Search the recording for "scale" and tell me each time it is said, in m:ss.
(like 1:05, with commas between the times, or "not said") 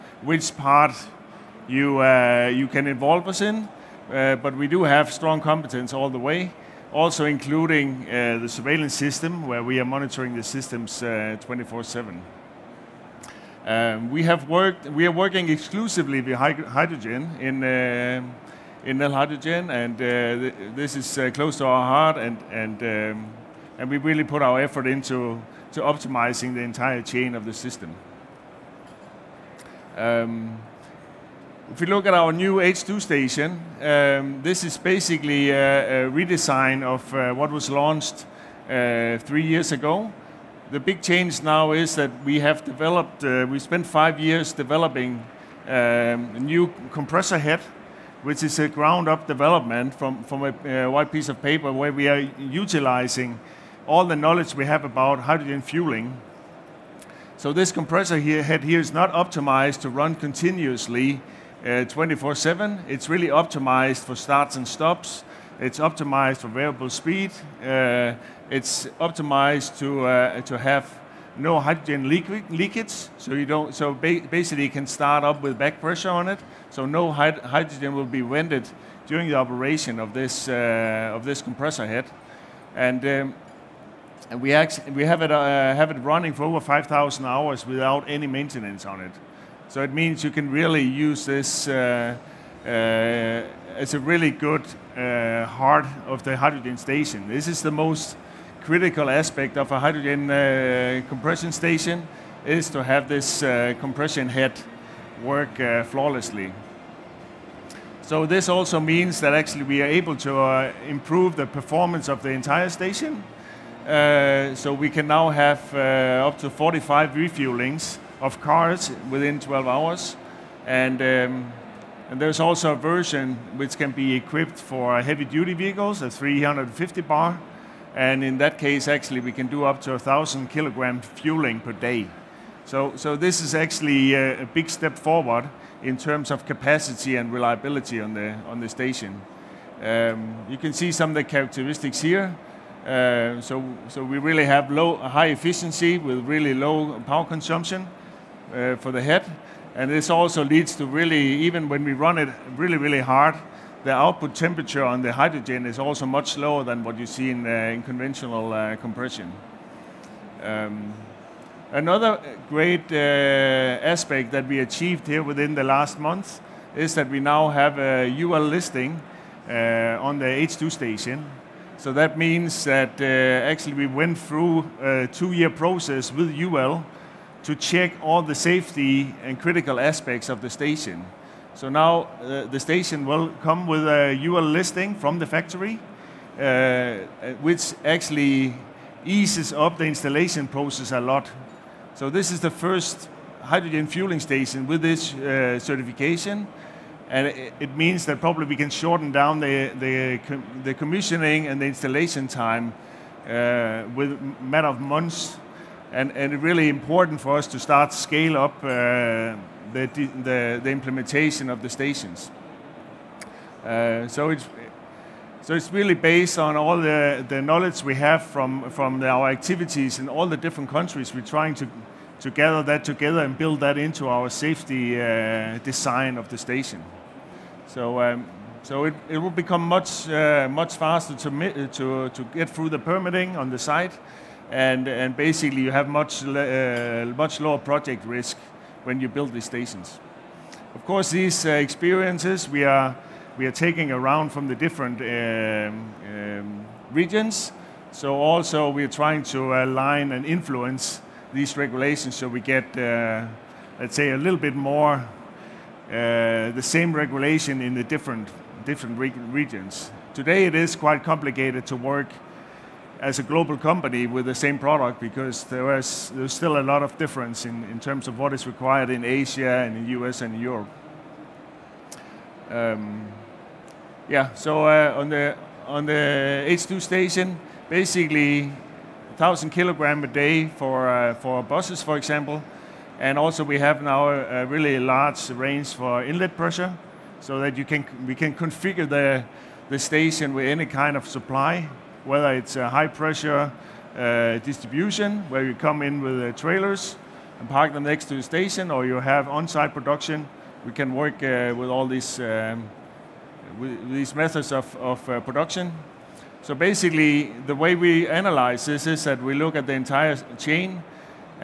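3:27.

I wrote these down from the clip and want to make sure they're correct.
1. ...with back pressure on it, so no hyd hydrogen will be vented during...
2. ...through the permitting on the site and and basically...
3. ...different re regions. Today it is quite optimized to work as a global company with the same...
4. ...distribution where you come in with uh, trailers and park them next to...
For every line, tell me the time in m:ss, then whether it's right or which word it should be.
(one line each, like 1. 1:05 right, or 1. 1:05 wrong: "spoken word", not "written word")
1. 1:15 right
2. 3:52 right
3. 4:18 wrong: "complicated", not "optimized"
4. 4:54 right.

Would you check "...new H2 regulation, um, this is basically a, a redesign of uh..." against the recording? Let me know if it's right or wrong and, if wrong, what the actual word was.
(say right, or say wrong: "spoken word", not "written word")
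wrong: "station", not "regulation".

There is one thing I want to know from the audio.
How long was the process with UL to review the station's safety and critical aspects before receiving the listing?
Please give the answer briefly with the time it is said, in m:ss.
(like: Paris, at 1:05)
2 years, at 2:55.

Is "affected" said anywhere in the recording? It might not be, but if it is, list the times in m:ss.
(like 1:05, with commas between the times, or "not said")
not said.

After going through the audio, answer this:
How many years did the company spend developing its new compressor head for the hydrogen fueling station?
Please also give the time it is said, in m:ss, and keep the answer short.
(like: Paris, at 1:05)
5 years, at 0:43.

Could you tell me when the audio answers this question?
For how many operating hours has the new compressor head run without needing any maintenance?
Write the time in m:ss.
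1:26.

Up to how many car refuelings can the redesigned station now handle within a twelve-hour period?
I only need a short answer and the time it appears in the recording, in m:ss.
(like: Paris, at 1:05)
45, at 1:56.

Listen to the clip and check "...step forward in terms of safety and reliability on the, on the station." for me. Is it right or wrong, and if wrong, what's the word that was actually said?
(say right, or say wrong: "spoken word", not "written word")
wrong: "capacity", not "safety".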